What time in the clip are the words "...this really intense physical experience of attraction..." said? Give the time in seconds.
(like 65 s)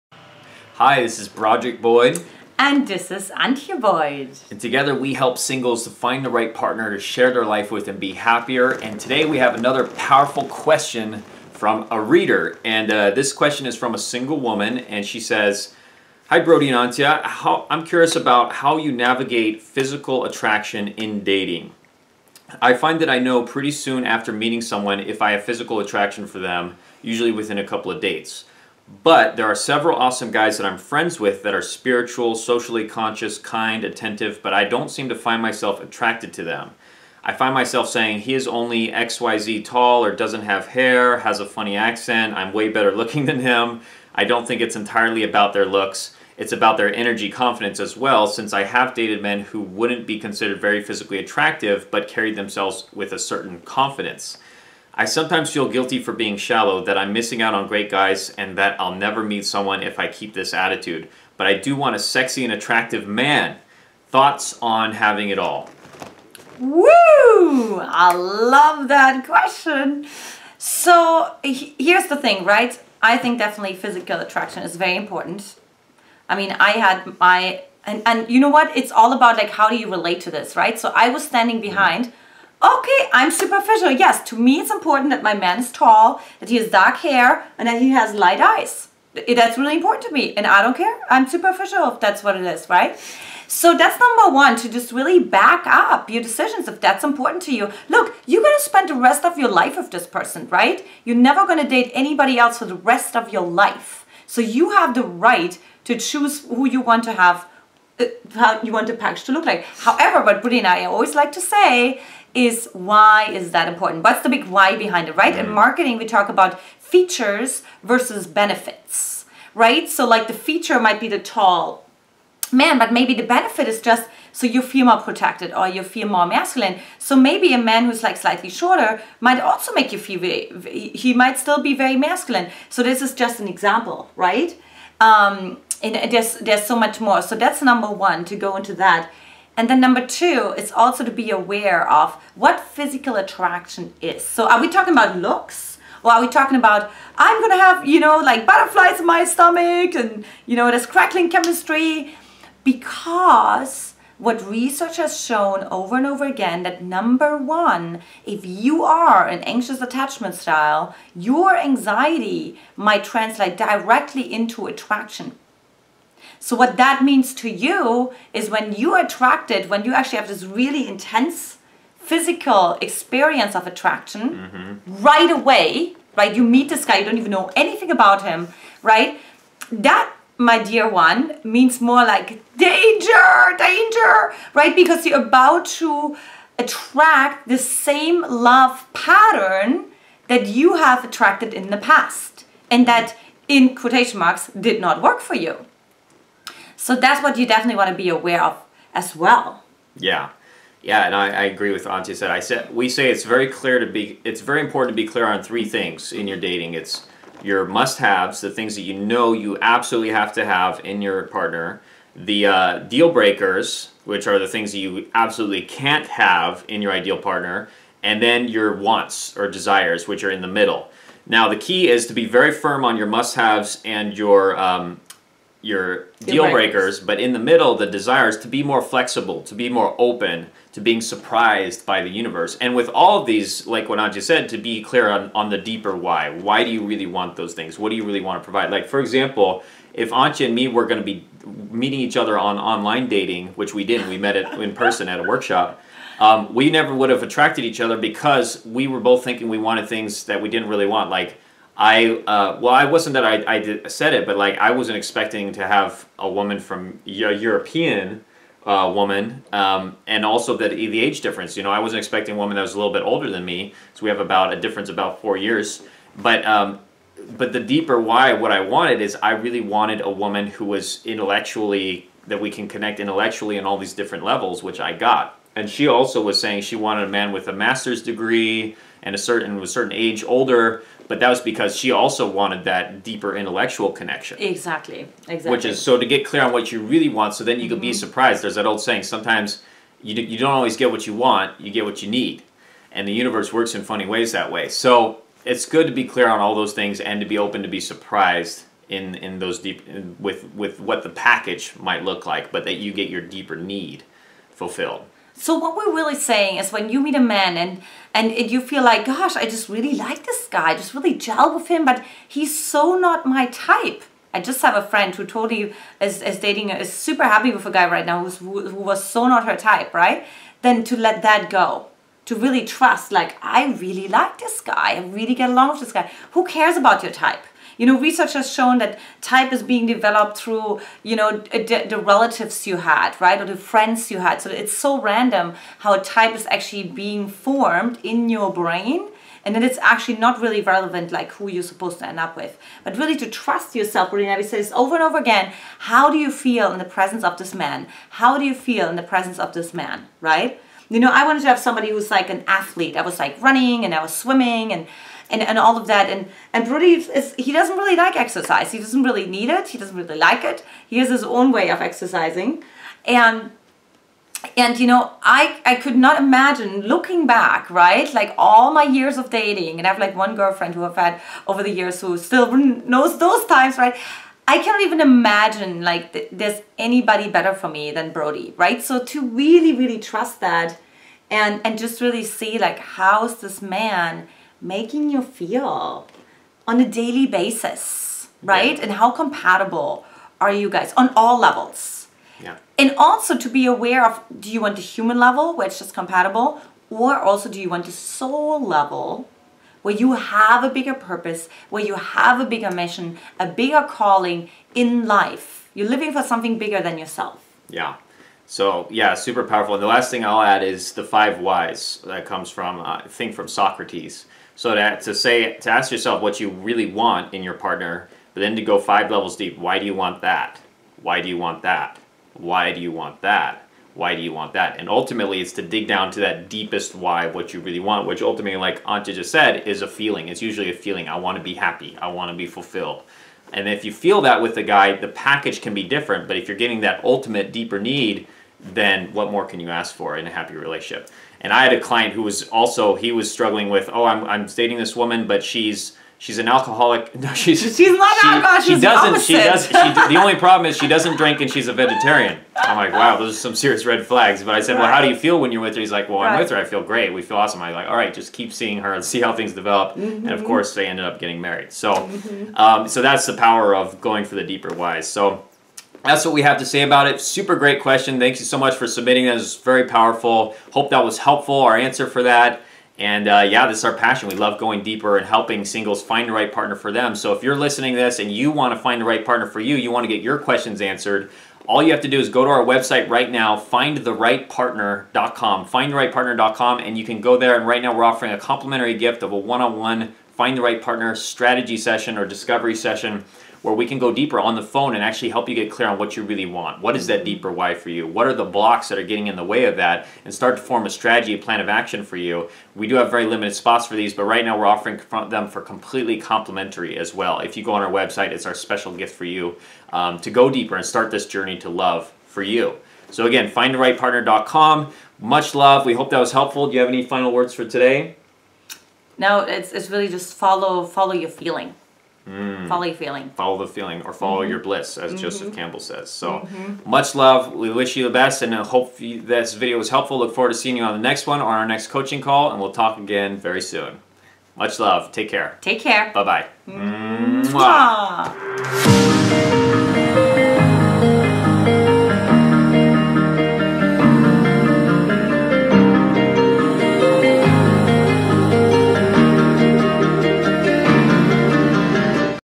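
170 s.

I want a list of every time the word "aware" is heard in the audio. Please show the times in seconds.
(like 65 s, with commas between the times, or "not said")
141 s, 198 s, 393 s.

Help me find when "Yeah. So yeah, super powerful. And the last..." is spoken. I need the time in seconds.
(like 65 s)
407 s.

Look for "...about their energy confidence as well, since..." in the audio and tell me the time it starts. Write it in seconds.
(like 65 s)
46 s.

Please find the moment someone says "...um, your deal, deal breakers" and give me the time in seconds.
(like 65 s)
224 s.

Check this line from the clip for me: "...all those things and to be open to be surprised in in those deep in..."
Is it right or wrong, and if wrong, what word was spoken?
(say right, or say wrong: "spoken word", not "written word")
right.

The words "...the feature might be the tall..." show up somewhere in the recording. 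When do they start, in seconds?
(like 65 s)
120 s.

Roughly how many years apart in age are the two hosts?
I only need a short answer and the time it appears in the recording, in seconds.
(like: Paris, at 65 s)
4, at 264 s.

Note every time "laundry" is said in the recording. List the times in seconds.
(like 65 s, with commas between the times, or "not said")
not said.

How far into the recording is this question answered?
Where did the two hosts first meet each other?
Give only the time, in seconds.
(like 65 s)
245 s.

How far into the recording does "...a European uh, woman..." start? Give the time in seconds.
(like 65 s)
257 s.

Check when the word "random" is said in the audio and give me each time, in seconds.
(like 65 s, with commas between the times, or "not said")
335 s.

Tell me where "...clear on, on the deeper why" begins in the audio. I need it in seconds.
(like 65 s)
234 s.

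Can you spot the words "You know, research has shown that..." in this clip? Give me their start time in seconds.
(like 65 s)
327 s.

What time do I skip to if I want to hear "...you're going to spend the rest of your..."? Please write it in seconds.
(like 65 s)
98 s.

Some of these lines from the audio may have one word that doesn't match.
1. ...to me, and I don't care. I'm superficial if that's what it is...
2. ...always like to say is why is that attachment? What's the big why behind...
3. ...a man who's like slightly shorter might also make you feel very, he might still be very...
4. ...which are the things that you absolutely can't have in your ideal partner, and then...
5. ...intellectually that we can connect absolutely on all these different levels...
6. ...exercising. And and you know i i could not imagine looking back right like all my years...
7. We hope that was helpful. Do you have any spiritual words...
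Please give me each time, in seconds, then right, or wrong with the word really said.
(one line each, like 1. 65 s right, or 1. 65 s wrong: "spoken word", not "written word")
1. 90 s right
2. 110 s wrong: "important", not "attachment"
3. 127 s right
4. 214 s right
5. 271 s wrong: "intellectually", not "absolutely"
6. 361 s right
7. 515 s wrong: "final", not "spiritual".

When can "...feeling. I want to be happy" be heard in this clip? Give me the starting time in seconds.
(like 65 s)
430 s.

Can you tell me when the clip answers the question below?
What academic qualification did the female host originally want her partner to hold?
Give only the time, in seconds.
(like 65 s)
277 s.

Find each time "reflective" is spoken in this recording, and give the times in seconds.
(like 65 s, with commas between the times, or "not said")
not said.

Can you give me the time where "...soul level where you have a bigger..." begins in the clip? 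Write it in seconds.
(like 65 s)
397 s.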